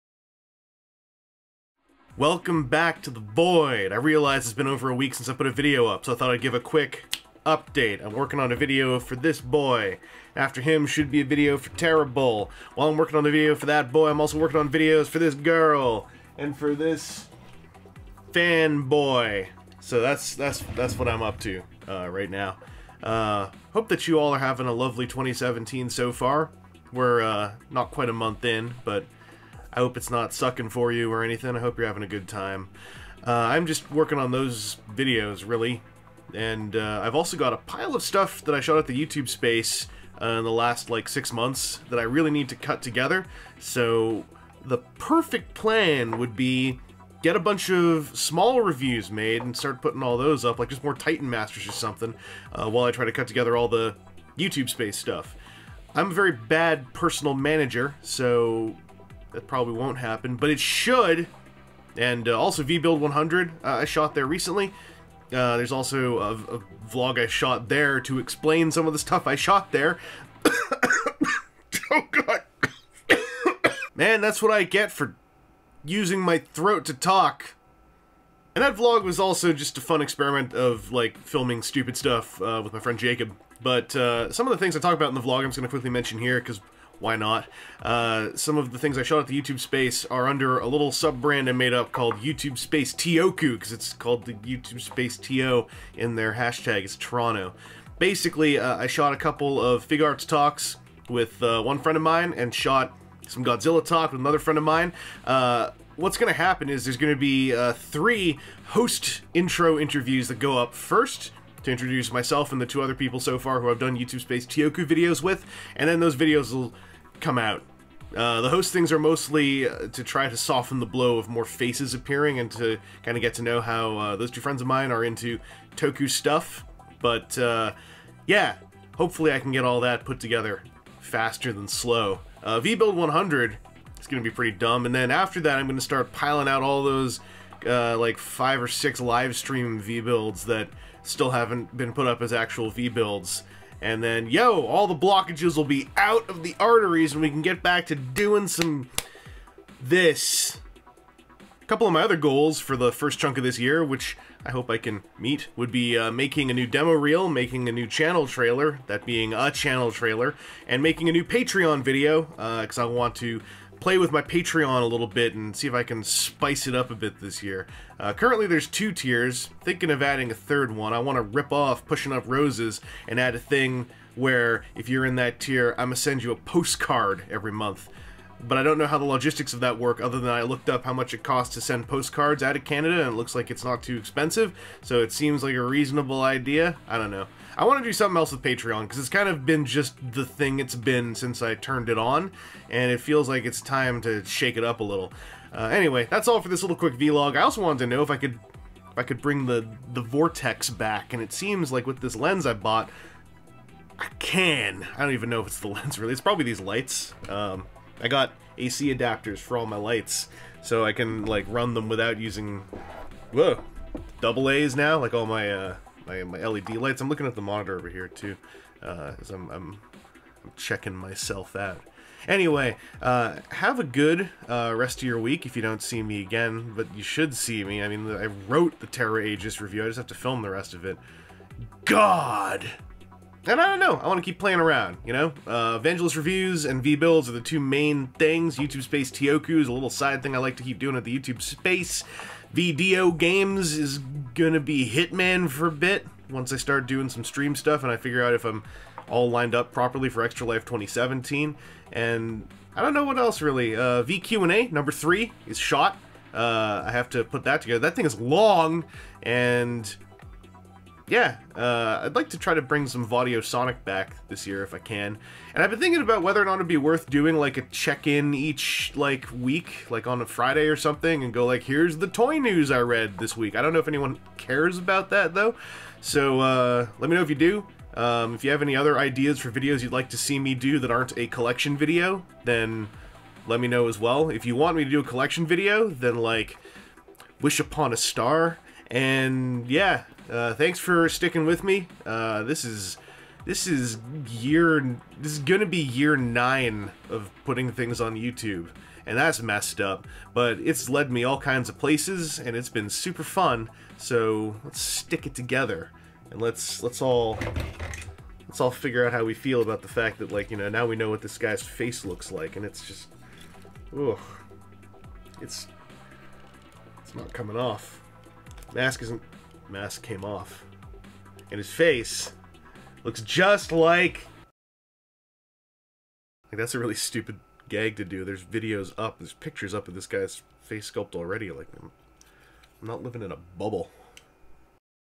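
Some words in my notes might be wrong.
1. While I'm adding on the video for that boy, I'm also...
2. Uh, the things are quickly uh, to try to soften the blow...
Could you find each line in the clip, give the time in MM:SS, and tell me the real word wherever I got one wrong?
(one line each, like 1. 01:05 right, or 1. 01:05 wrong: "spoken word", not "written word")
1. 00:12 wrong: "working", not "adding"
2. 01:58 wrong: "mostly", not "quickly".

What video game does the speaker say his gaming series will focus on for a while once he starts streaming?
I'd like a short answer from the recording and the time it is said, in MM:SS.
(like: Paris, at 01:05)
Hitman, at 04:04.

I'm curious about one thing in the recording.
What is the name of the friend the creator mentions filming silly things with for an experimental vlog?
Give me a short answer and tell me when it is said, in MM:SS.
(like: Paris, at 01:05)
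Jacob, at 01:22.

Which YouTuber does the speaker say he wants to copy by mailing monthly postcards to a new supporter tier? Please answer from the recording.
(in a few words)
Pushing Up Roses.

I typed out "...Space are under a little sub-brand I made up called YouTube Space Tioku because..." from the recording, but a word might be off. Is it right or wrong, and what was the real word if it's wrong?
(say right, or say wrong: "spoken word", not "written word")
right.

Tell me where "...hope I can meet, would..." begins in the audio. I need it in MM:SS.
02:34.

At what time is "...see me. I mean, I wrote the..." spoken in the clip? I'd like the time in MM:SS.
03:47.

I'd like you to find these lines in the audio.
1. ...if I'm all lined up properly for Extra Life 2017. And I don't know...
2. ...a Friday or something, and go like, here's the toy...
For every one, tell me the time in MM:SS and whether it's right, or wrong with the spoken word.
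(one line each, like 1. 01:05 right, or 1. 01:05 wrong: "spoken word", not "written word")
1. 04:08 right
2. 04:30 right.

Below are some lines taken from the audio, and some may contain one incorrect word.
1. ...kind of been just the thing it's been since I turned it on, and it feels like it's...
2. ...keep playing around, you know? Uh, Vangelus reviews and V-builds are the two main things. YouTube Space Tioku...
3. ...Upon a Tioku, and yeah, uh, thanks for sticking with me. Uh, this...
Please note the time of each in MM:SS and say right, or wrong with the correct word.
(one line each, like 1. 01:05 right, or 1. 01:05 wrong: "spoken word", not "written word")
1. 03:09 right
2. 03:54 right
3. 04:47 wrong: "Star", not "Tioku".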